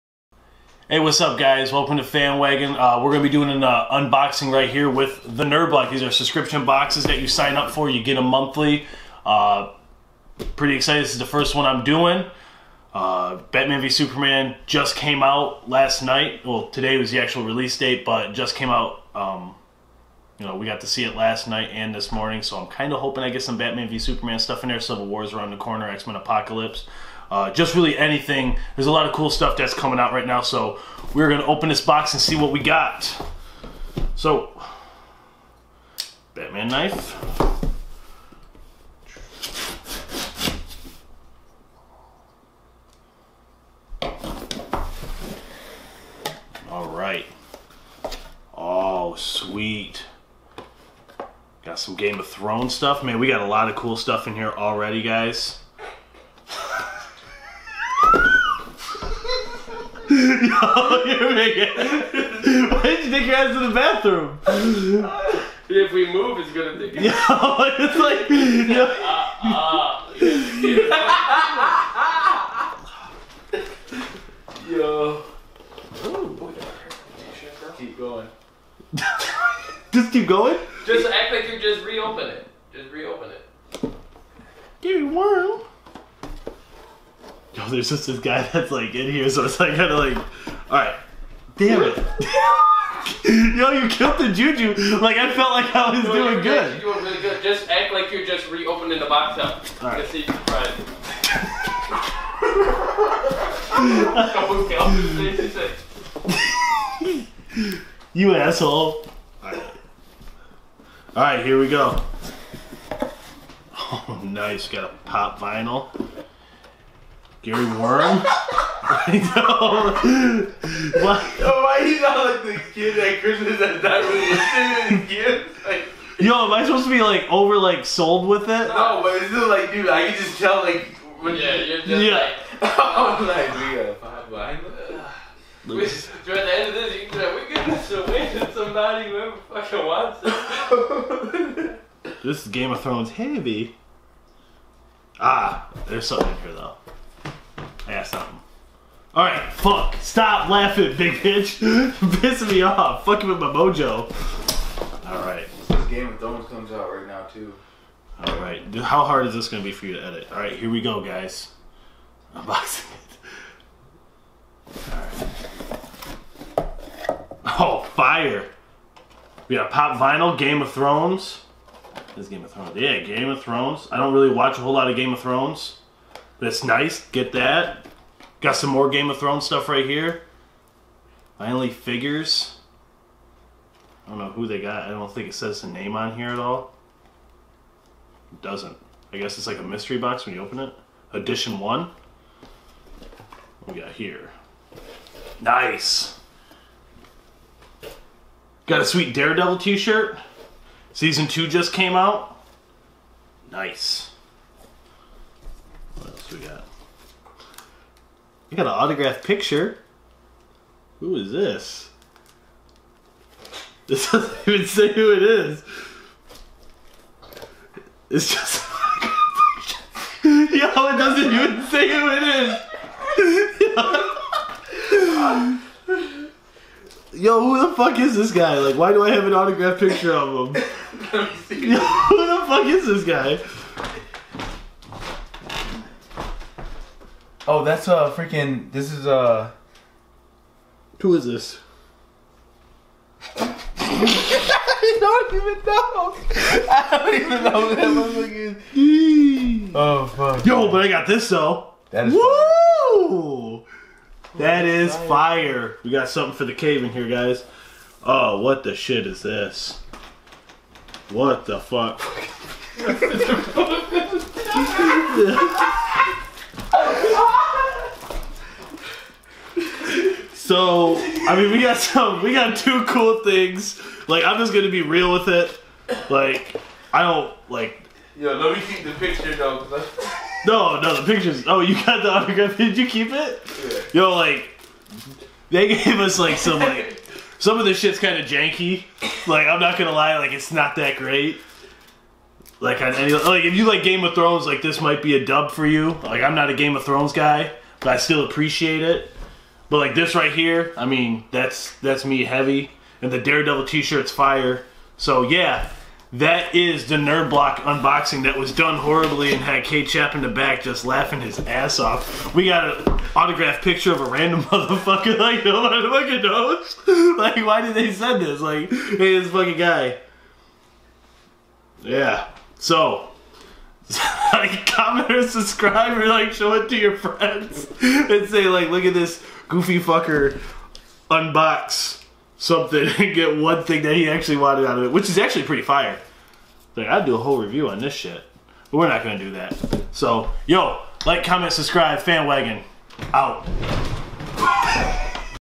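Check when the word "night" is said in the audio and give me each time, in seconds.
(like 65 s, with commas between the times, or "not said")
16 s, 21 s.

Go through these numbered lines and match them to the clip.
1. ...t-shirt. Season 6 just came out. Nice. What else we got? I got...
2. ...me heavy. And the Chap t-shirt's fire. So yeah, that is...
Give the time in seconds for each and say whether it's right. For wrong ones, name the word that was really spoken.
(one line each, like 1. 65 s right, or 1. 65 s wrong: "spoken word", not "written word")
1. 199 s wrong: "2", not "6"
2. 302 s wrong: "Daredevil", not "Chap".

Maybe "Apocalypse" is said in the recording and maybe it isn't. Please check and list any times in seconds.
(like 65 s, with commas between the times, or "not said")
26 s.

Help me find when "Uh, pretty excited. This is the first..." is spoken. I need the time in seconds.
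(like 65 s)
9 s.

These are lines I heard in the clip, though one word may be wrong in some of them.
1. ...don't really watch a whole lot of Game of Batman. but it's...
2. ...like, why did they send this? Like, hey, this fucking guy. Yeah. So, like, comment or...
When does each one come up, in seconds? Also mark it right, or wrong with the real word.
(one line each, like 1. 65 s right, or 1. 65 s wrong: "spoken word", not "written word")
1. 173 s wrong: "Thrones", not "Batman"
2. 317 s right.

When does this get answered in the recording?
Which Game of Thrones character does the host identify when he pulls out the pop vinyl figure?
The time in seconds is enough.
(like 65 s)
117 s.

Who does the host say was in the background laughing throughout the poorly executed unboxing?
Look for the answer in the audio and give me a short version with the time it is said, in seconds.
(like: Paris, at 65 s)
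K Chap, at 309 s.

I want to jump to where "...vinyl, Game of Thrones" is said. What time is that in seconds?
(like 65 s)
169 s.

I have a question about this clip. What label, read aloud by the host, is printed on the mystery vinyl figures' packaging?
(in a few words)
Edition 1.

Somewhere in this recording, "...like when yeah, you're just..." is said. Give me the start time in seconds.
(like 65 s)
130 s.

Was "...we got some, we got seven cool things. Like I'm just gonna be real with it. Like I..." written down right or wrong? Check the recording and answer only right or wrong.
wrong.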